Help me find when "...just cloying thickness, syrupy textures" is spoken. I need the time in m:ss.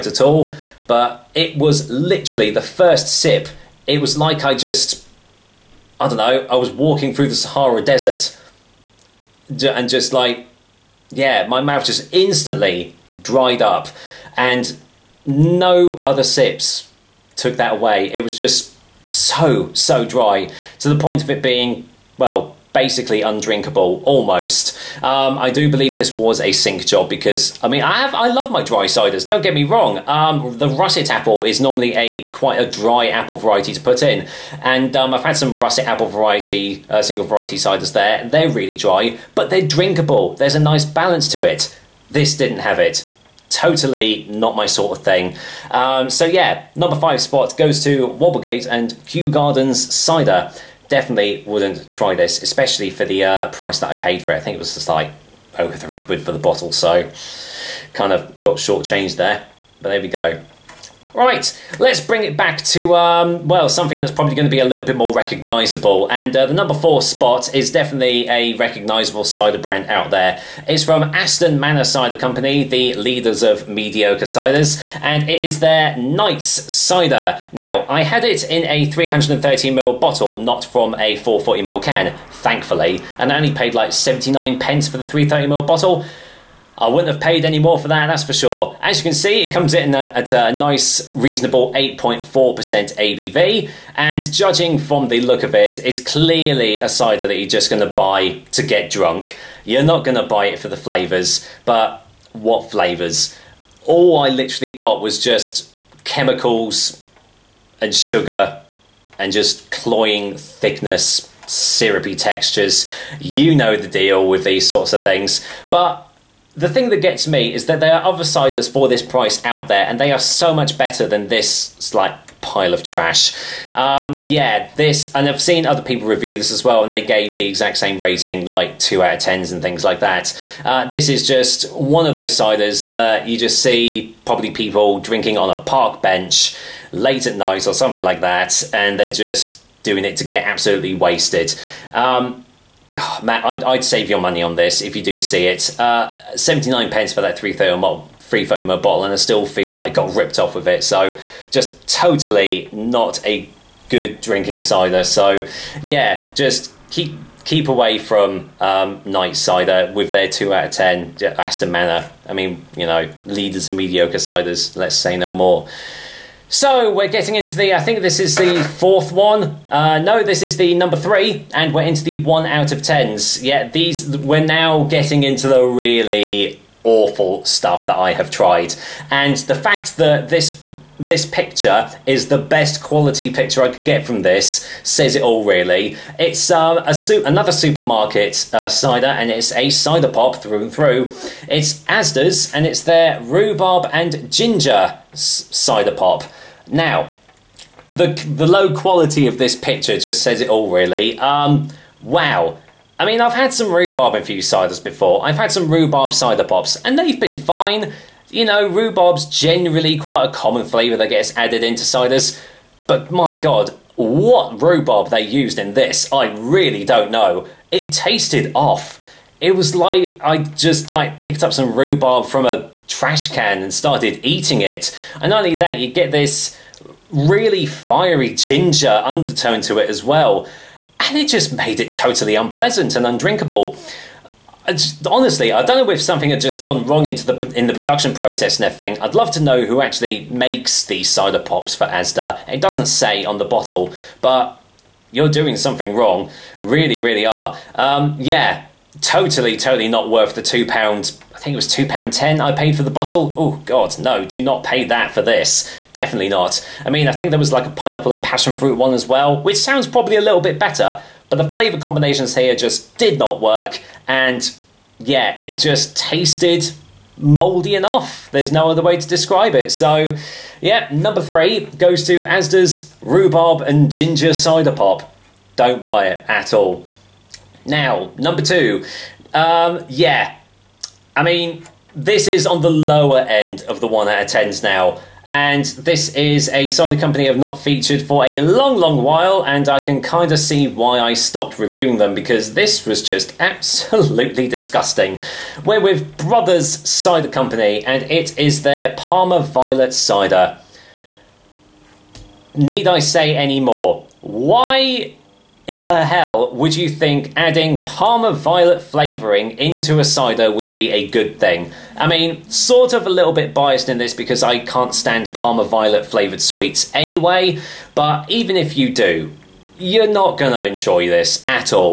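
1:49.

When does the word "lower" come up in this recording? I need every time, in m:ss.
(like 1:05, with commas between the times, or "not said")
4:42.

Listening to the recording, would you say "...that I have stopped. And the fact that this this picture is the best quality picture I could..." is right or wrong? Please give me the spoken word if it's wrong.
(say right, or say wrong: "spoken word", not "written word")
wrong: "tried", not "stopped".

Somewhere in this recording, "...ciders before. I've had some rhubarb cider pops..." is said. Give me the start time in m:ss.
3:24.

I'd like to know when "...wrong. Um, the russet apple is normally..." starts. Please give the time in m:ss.
0:29.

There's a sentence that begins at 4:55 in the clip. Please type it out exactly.
We're with Brothers Cider Company, and it is their Parma Violet Cider.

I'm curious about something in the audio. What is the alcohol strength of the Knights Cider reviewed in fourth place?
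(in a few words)
8.4%.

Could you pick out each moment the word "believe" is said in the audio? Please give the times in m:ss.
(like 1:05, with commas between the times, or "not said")
0:25.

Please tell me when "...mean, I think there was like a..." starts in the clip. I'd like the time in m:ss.
4:16.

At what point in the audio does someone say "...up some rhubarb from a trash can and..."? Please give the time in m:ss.
3:41.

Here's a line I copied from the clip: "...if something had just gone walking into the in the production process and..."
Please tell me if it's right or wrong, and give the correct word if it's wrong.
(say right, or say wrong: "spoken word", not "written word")
wrong: "wrong", not "walking".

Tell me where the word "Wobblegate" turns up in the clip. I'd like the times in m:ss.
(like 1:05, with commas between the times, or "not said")
0:48.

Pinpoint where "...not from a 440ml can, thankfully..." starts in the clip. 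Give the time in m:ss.
1:20.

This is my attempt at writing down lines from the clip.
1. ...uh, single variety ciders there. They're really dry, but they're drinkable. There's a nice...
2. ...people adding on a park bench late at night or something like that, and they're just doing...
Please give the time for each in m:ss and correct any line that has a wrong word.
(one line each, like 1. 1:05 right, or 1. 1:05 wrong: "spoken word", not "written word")
1. 0:36 right
2. 2:14 wrong: "drinking", not "adding".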